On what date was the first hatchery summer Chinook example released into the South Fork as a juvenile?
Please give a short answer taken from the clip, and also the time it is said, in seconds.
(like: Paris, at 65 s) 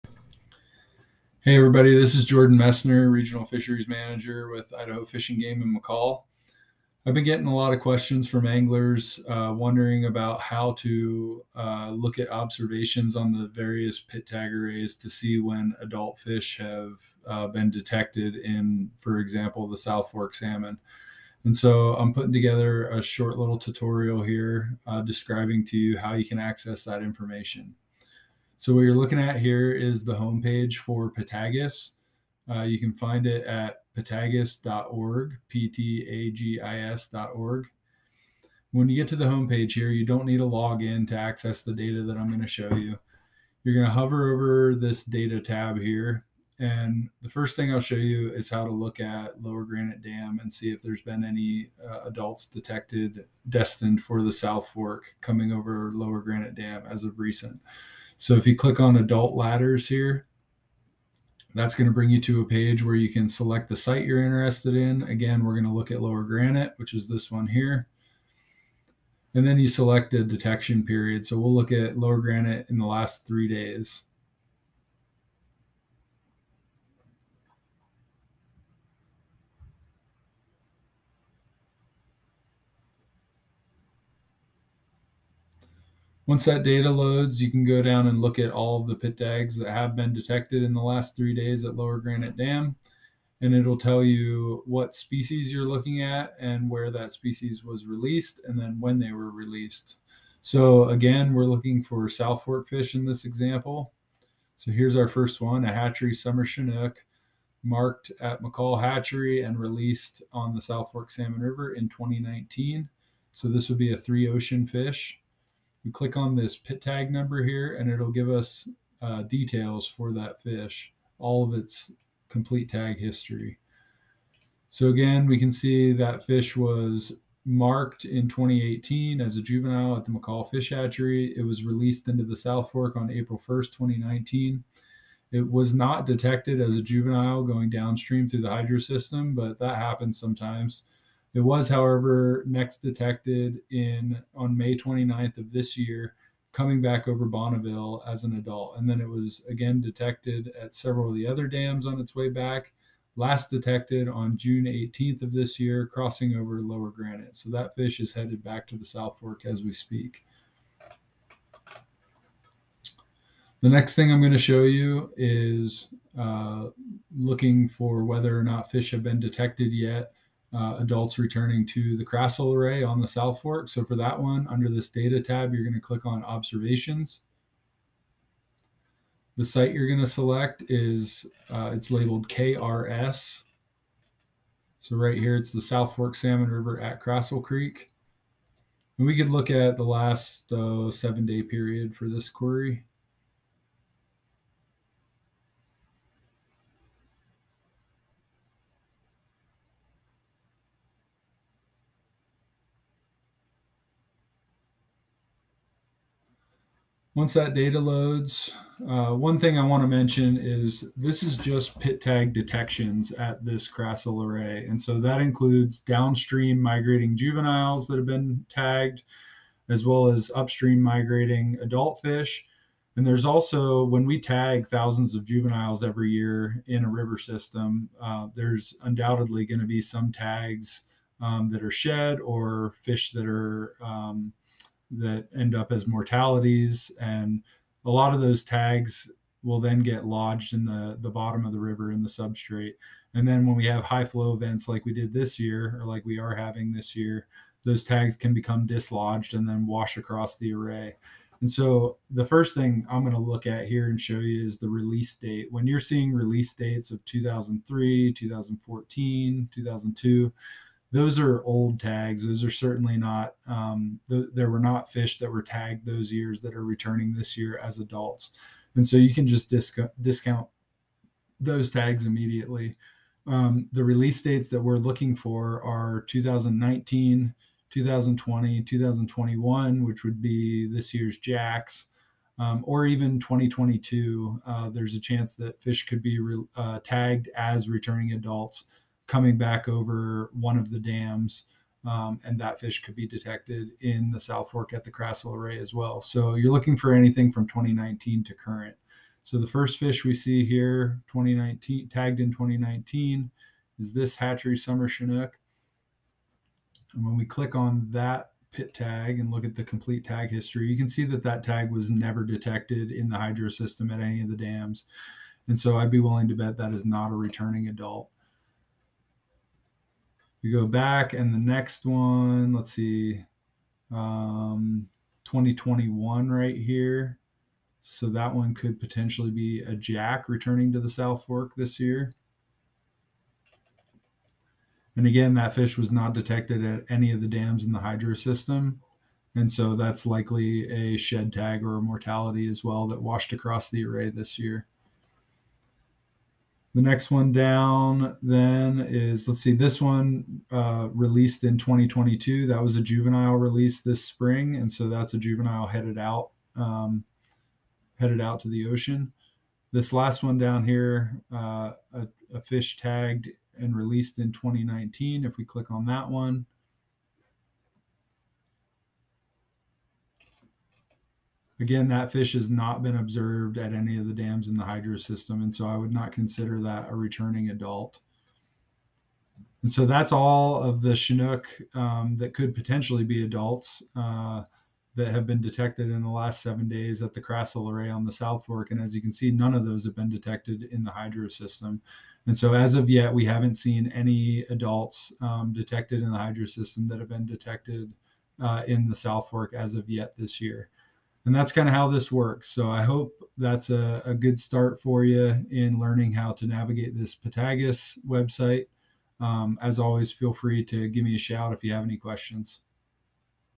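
April 1st, 2019, at 133 s.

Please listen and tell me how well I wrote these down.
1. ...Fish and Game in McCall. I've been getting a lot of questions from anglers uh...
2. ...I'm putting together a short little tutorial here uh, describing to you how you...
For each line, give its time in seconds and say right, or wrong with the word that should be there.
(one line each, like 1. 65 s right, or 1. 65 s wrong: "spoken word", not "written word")
1. 5 s right
2. 21 s right.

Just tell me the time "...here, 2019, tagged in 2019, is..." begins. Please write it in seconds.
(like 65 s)
300 s.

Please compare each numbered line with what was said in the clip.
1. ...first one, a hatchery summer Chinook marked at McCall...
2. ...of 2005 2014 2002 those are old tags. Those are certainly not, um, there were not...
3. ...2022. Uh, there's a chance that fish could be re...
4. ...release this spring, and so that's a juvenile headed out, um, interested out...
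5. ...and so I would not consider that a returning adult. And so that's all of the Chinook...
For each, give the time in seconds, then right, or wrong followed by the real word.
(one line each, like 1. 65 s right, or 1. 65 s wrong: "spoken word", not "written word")
1. 105 s right
2. 256 s wrong: "2003", not "2005"
3. 283 s right
4. 353 s wrong: "headed", not "interested"
5. 375 s right.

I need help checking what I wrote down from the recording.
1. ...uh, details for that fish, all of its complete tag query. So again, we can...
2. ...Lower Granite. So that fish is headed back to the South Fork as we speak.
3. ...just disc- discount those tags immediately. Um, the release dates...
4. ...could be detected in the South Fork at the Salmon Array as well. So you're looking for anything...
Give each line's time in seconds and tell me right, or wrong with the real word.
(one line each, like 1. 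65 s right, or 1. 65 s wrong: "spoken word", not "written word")
1. 119 s wrong: "history", not "query"
2. 156 s right
3. 269 s right
4. 292 s wrong: "Krassel", not "Salmon".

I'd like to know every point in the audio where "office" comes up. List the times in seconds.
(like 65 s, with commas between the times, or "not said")
not said.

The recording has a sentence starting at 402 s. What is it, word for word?
So I hope that's a, a, good start for you in learning how to navigate this PTAGIS website.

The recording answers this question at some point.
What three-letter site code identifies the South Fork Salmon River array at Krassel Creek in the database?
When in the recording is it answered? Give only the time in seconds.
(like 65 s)
182 s.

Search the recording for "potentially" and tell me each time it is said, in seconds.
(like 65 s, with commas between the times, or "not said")
328 s, 382 s.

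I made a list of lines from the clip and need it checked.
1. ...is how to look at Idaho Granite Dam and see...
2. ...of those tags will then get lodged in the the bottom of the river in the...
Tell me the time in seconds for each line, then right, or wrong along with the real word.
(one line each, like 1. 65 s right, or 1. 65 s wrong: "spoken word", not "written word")
1. 48 s wrong: "Lower", not "Idaho"
2. 238 s right.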